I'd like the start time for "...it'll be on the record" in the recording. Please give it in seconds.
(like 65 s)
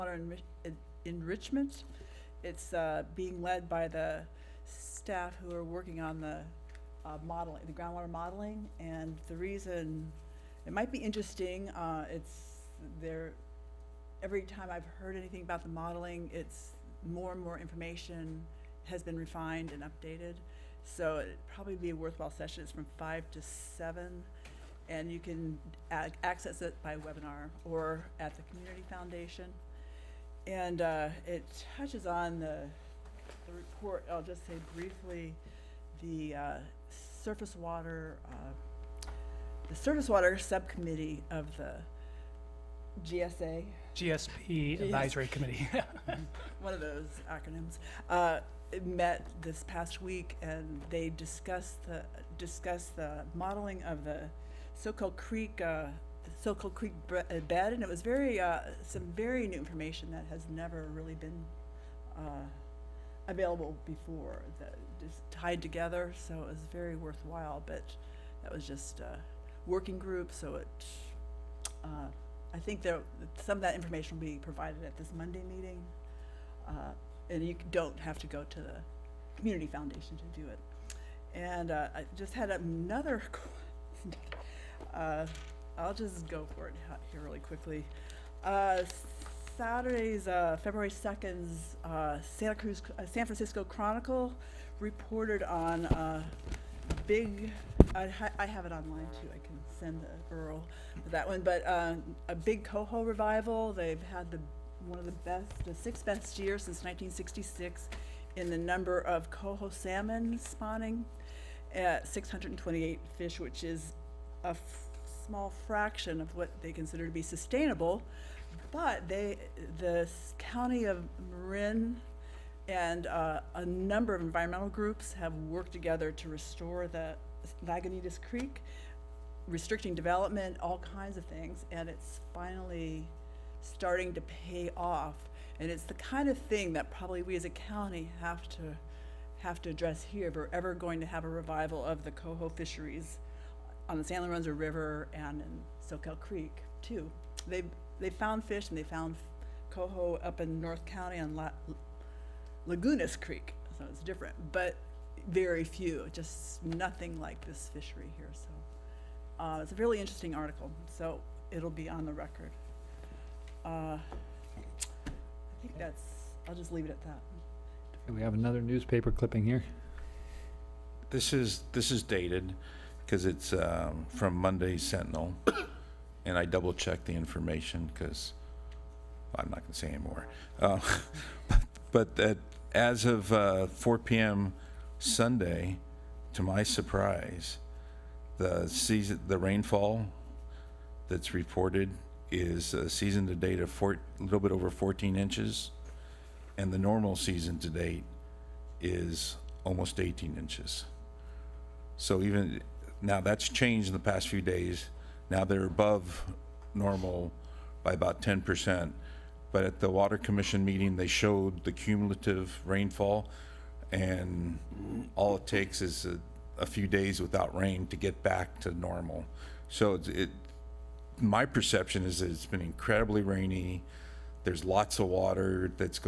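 161 s.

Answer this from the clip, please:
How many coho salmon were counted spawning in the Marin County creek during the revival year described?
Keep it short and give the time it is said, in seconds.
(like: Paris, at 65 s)
628, at 112 s.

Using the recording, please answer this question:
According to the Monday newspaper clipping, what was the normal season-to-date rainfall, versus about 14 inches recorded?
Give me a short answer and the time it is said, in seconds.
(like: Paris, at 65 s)
almost 18 inches, at 199 s.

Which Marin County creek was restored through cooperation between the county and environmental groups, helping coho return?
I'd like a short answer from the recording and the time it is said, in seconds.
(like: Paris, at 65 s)
Lagunitas Creek, at 127 s.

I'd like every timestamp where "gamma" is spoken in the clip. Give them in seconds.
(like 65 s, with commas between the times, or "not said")
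not said.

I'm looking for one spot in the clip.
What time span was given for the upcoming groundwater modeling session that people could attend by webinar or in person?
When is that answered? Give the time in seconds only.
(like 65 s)
22 s.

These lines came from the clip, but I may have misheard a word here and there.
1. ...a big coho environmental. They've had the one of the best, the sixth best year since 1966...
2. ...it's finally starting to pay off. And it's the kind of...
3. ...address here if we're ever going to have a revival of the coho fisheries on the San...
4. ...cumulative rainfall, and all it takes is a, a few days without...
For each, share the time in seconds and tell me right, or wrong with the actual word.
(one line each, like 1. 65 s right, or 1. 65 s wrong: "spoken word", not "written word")
1. 101 s wrong: "revival", not "environmental"
2. 131 s right
3. 139 s right
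4. 211 s right.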